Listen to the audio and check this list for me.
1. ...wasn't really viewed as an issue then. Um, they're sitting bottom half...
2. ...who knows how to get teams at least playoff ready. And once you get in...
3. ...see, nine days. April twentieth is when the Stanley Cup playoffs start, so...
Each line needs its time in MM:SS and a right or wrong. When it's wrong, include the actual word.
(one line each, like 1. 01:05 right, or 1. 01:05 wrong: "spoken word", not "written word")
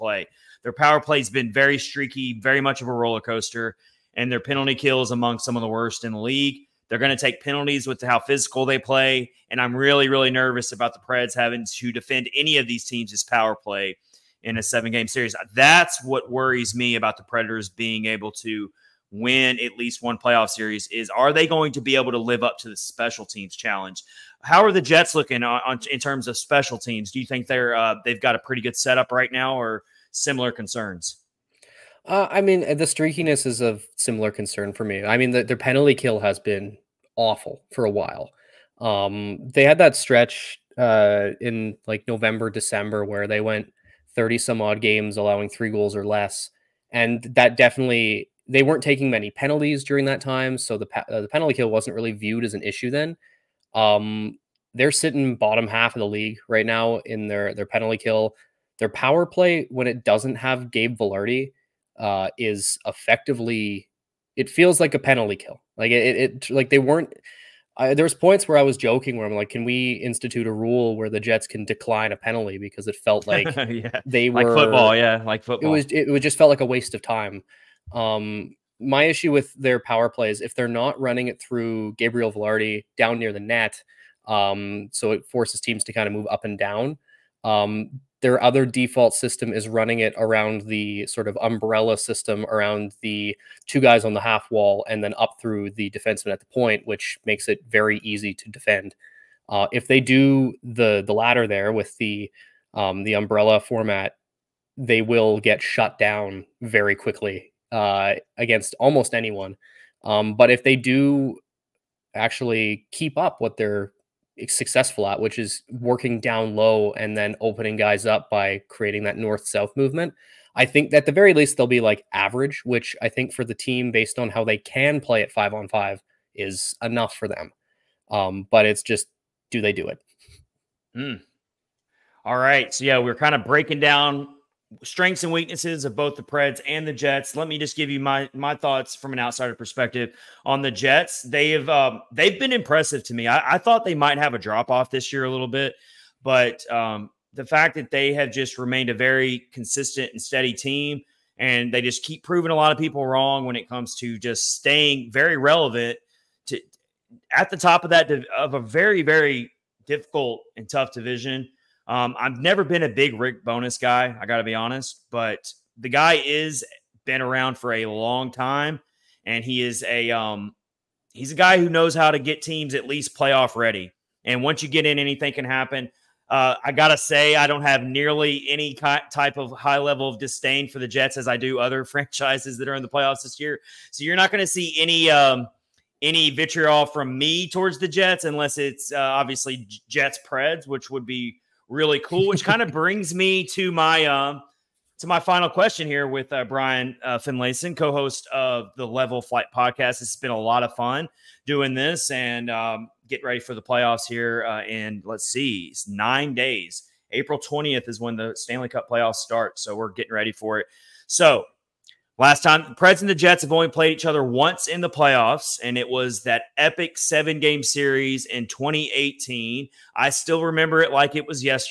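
1. 00:51 right
2. 02:51 right
3. 03:25 right.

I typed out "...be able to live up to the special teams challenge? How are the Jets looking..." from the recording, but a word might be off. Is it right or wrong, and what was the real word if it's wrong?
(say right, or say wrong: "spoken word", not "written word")
right.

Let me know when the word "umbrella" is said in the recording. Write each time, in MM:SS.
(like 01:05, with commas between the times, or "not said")
01:31, 01:43.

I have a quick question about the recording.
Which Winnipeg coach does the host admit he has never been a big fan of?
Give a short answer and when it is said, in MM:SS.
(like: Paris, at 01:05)
Rick Bowness, at 02:43.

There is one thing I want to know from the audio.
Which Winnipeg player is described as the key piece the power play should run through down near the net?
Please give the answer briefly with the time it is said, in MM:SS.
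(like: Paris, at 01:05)
Gabe Vilardi, at 01:00.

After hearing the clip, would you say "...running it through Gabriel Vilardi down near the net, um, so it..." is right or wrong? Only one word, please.
right.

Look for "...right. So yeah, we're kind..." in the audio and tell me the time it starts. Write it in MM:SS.
02:12.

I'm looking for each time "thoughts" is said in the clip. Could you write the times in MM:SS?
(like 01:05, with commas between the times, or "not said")
02:18, 02:23.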